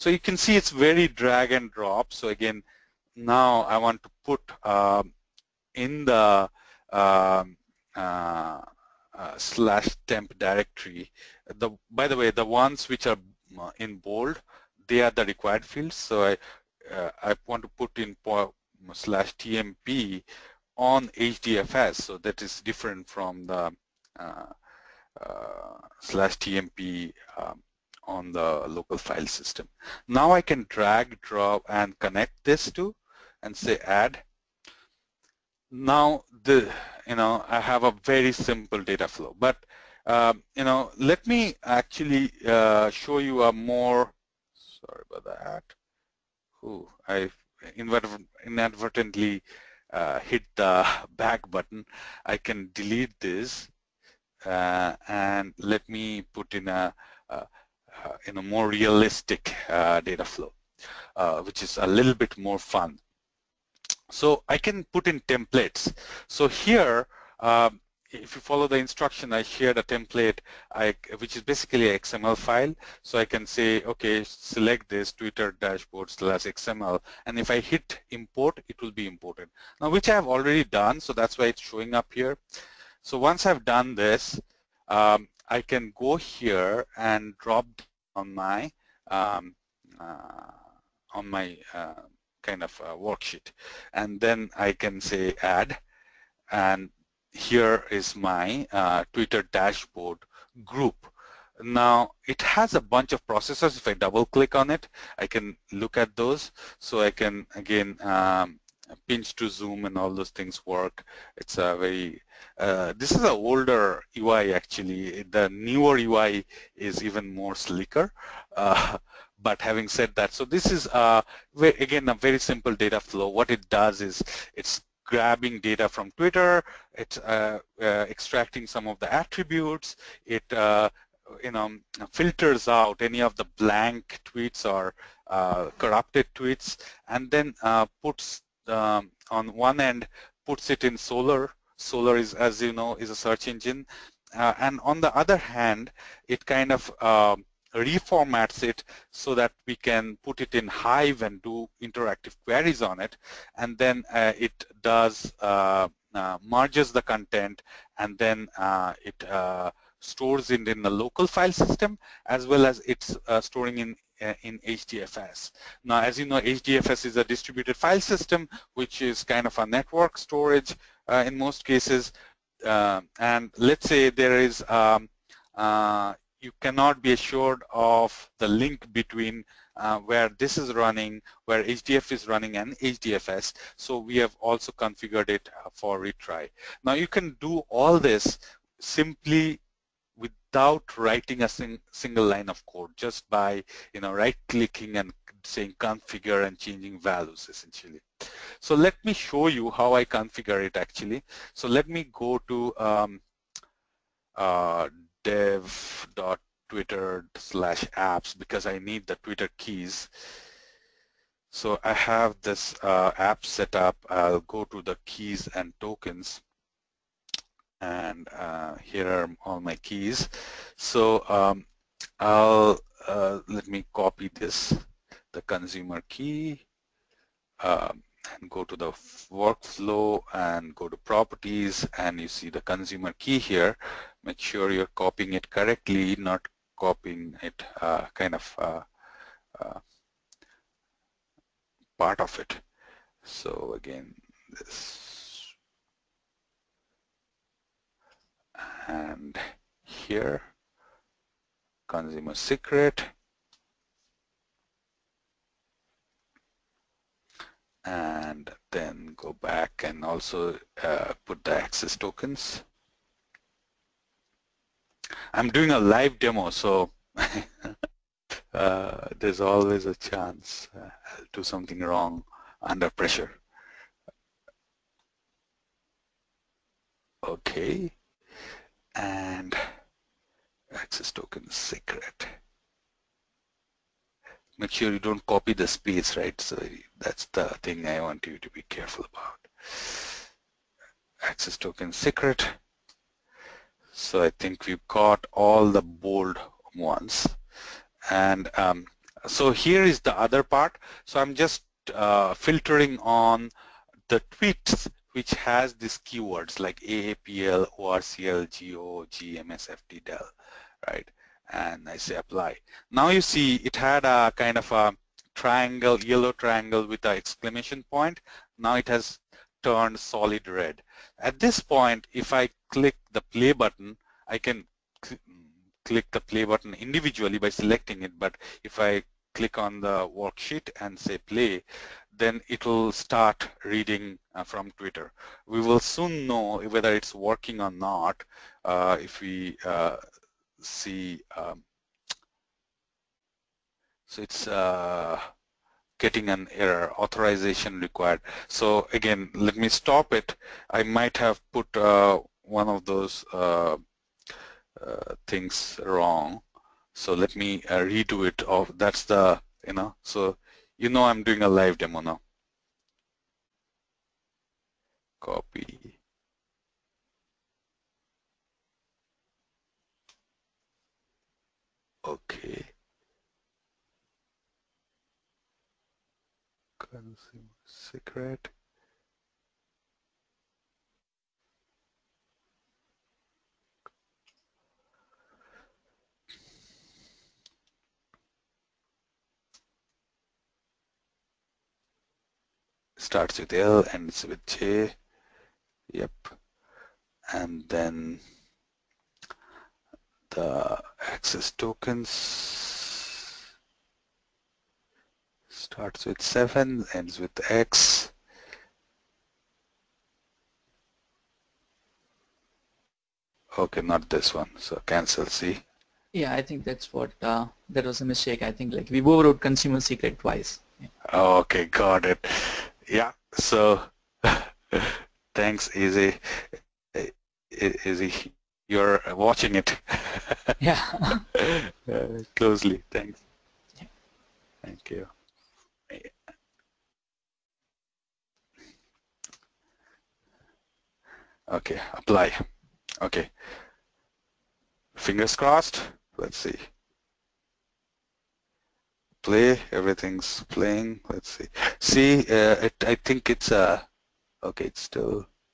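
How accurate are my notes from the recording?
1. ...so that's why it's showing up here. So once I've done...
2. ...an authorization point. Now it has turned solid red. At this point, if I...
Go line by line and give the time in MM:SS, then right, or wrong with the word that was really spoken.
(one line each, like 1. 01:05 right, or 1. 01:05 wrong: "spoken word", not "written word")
1. 01:20 right
2. 05:17 wrong: "exclamation", not "authorization".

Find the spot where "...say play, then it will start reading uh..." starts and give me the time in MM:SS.
05:30.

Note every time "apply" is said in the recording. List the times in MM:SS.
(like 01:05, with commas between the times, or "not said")
05:12, 07:21.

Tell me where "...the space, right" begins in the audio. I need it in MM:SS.
04:45.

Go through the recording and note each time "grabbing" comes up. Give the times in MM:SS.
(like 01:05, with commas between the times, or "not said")
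02:05.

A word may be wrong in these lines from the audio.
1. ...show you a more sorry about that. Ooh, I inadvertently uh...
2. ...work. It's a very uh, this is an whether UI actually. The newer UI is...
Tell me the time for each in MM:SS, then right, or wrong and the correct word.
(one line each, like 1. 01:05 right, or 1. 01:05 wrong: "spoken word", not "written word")
1. 00:42 right
2. 01:50 wrong: "older", not "whether".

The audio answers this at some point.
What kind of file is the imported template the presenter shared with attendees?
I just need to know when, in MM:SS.
01:11.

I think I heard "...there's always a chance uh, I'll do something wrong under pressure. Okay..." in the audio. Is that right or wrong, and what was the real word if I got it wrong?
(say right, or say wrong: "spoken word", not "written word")
right.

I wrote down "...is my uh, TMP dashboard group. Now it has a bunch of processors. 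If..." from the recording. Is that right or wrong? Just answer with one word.
wrong.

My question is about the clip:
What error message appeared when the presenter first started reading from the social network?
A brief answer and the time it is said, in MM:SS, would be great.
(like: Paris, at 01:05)
authorization required, at 05:46.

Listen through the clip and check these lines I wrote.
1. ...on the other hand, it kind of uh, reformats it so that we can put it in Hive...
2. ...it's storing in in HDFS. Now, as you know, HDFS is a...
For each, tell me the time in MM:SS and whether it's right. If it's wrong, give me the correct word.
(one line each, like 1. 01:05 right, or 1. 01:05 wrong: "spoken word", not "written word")
1. 02:24 right
2. 02:42 right.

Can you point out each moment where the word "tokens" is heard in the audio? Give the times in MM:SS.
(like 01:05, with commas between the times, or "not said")
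03:35, 04:21, 04:41, 04:51, 06:41.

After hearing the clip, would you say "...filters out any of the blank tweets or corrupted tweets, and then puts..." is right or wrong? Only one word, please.
right.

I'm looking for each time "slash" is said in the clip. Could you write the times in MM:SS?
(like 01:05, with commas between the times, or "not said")
00:09, 00:18, 00:25, 01:16, 03:27.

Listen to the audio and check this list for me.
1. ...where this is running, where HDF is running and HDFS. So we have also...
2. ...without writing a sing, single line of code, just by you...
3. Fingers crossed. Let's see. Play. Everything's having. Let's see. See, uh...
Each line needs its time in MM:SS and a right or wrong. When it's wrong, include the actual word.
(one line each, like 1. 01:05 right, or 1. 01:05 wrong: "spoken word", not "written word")
1. 02:59 right
2. 03:10 right
3. 07:24 wrong: "playing", not "having".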